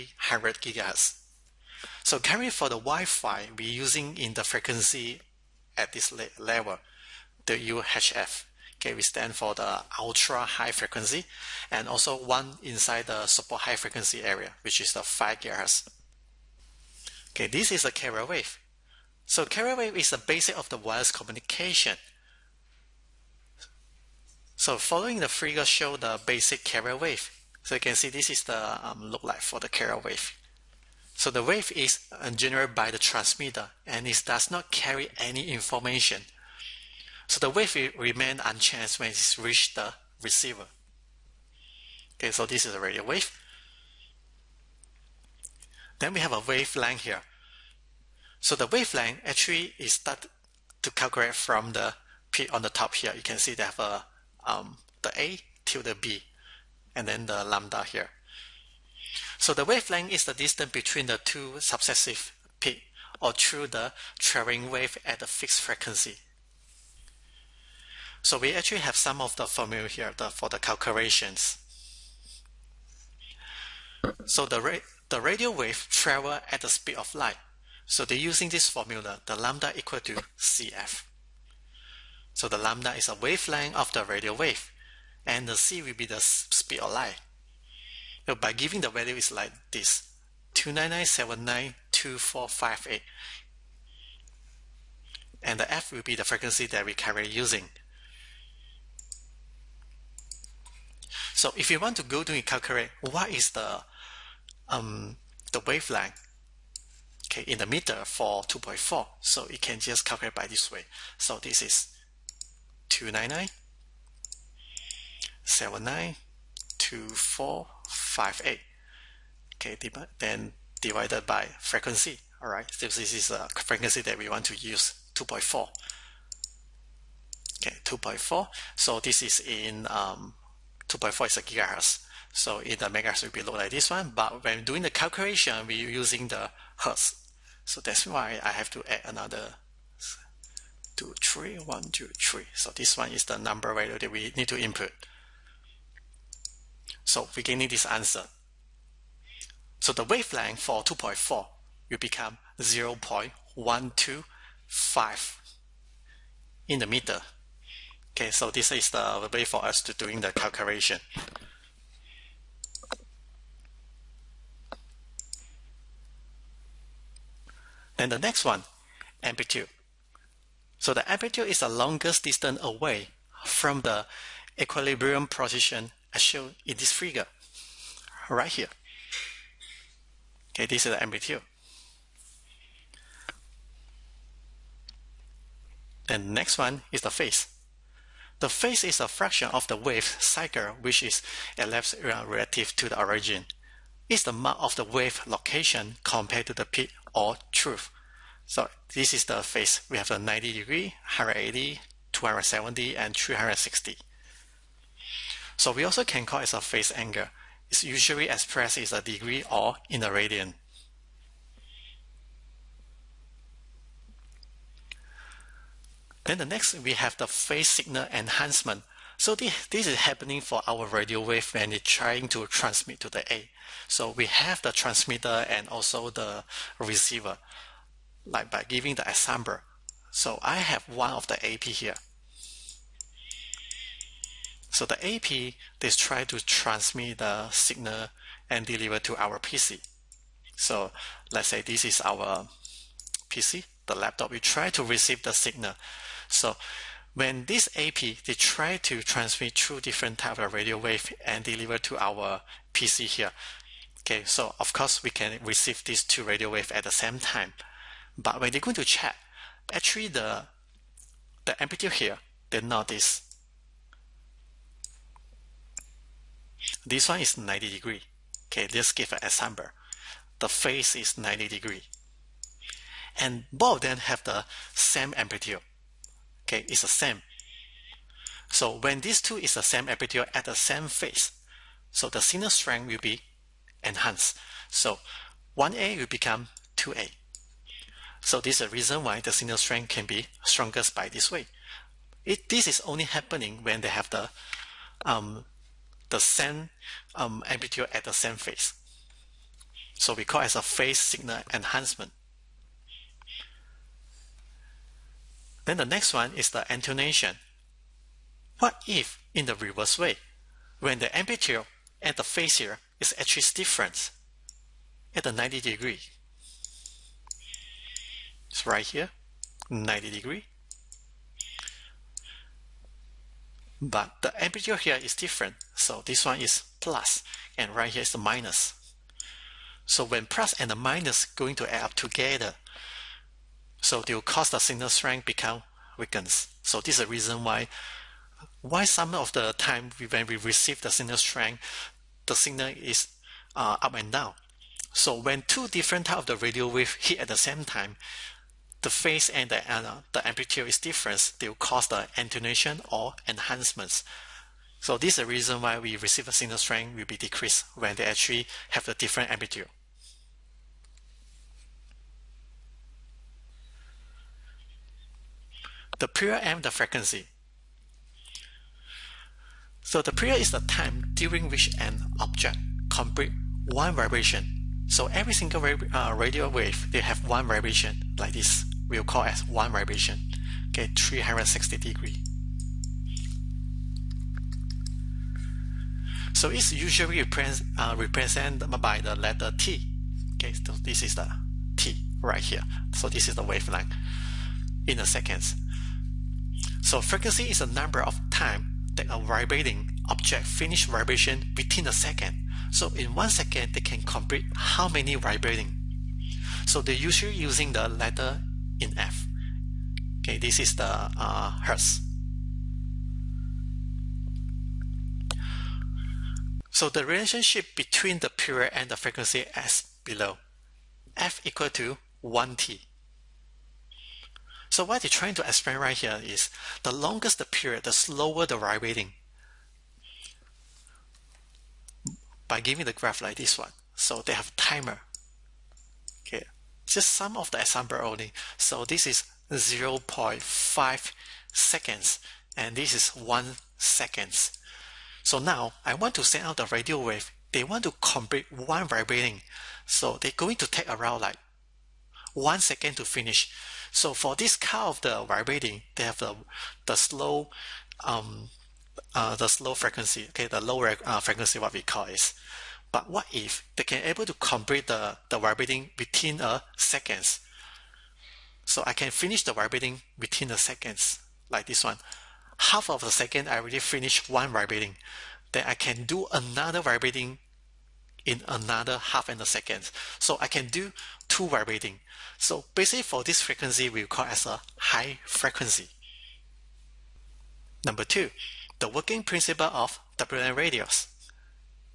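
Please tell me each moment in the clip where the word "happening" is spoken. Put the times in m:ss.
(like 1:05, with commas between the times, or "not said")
3:39, 4:53.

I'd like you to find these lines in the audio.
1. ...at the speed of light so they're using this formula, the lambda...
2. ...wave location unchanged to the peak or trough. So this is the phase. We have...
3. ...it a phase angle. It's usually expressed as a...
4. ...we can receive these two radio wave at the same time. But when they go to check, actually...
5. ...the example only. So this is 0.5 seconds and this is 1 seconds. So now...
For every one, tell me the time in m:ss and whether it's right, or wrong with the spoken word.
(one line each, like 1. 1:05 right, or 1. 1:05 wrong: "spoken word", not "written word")
1. 1:16 right
2. 3:14 wrong: "compared", not "unchanged"
3. 3:26 right
4. 4:15 right
5. 7:17 right.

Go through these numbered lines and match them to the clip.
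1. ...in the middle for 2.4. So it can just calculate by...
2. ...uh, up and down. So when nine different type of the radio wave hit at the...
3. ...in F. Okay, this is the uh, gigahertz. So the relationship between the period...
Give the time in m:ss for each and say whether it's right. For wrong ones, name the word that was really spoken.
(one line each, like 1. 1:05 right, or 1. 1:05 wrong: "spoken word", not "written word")
1. 1:47 right
2. 5:43 wrong: "two", not "nine"
3. 6:48 wrong: "hertz", not "gigahertz".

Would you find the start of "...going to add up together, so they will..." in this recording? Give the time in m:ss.
5:31.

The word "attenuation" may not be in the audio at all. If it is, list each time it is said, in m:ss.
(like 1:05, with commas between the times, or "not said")
5:06, 5:52.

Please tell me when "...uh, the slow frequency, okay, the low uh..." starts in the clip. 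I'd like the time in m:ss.
7:39.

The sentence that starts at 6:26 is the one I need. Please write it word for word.
So it's usually uh, represent, represented by the letter T.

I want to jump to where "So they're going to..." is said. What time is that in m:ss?
7:29.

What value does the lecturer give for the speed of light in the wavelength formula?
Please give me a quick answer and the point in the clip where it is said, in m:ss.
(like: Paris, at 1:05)
299792458, at 1:30.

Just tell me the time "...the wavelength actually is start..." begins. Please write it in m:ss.
0:48.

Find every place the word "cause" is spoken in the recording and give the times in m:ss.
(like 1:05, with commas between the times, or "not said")
5:34, 5:51.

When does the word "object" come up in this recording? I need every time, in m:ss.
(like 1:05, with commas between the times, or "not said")
6:12, 6:40.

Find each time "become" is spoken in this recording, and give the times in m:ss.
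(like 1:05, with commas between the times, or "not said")
2:31, 4:46, 5:35.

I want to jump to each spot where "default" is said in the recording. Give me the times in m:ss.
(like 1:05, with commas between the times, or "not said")
not said.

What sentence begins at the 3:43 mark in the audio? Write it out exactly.
So we have the transmitter and also the receiver like by giving the example.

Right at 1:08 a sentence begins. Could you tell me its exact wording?
So we actually have some of the formula here the, for the calculations.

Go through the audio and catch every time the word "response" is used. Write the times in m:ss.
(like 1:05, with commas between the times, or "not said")
not said.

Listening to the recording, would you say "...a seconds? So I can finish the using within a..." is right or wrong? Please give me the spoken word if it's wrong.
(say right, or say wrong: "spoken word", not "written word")
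wrong: "vibrating", not "using".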